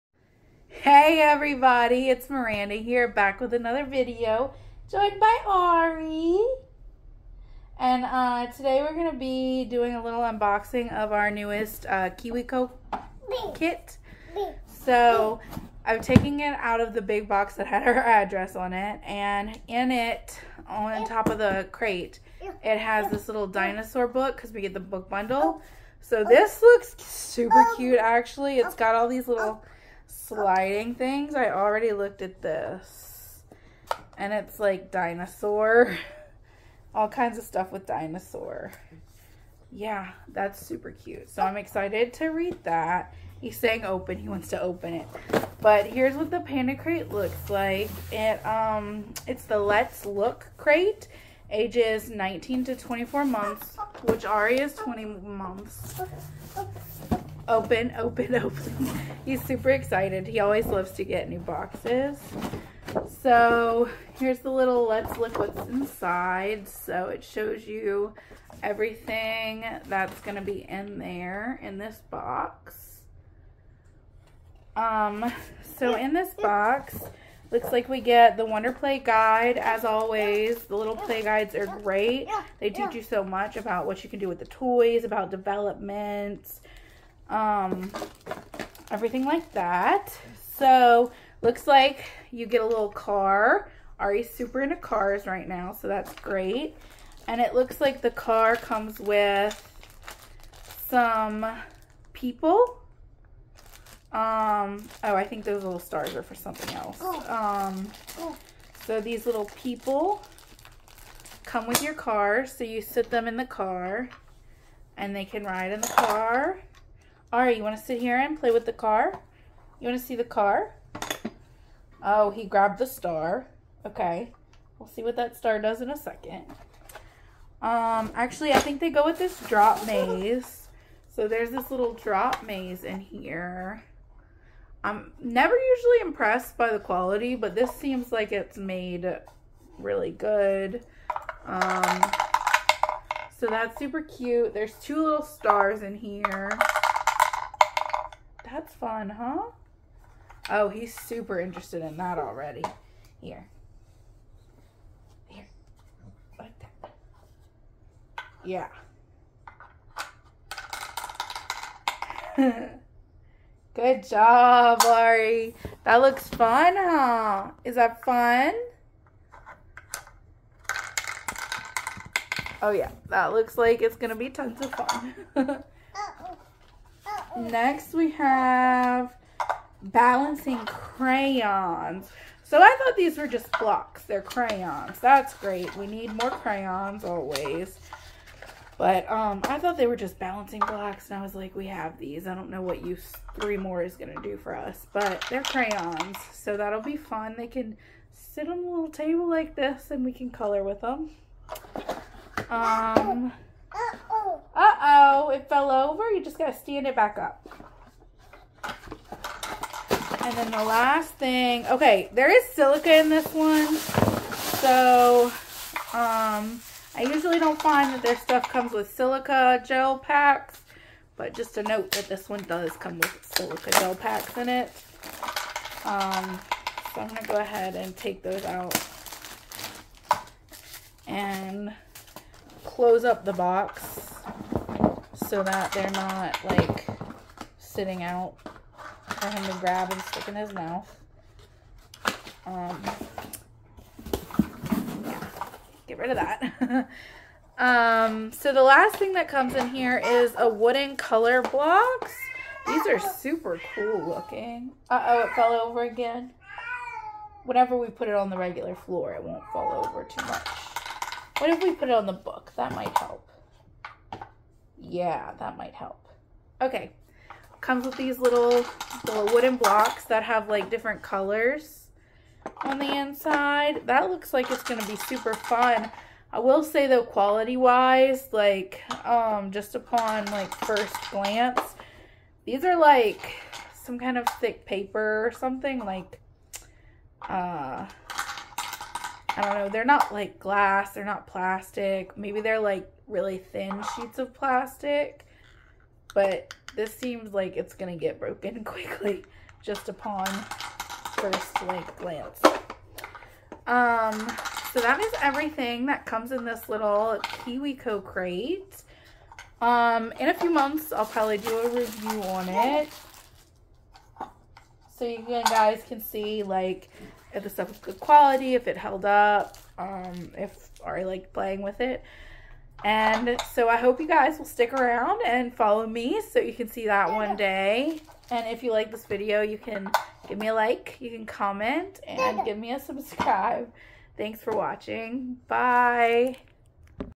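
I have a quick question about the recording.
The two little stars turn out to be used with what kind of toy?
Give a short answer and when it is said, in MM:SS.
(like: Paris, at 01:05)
drop maze, at 02:11.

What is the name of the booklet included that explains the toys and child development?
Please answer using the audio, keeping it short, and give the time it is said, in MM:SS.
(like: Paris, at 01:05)
Wonder Play Guide, at 01:18.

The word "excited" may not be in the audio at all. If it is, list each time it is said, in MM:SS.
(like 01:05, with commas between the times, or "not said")
00:41, 00:59.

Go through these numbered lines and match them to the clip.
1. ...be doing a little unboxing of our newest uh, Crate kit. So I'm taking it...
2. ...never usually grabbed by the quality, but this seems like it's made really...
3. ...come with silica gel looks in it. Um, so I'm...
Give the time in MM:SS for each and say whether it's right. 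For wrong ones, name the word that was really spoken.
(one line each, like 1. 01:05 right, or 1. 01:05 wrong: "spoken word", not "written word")
1. 00:09 wrong: "KiwiCo", not "Crate"
2. 02:15 wrong: "impressed", not "grabbed"
3. 03:42 wrong: "packs", not "looks".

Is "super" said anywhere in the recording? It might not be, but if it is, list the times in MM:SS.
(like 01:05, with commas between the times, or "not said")
00:26, 00:40, 00:59, 01:34, 02:23, 02:30, 04:12, 04:34.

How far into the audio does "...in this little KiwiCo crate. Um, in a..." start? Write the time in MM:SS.
05:06.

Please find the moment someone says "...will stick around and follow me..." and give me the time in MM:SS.
05:24.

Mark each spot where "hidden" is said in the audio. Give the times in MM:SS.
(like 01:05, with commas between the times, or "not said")
not said.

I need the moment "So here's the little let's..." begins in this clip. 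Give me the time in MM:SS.
01:03.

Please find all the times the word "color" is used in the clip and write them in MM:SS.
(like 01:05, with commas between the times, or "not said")
03:20, 04:10, 04:31.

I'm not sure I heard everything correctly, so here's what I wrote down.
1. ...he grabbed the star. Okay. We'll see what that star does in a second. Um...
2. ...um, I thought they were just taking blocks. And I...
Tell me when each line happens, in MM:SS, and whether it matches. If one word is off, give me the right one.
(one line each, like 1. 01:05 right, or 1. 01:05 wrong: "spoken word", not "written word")
1. 02:02 right
2. 03:09 wrong: "balancing", not "taking".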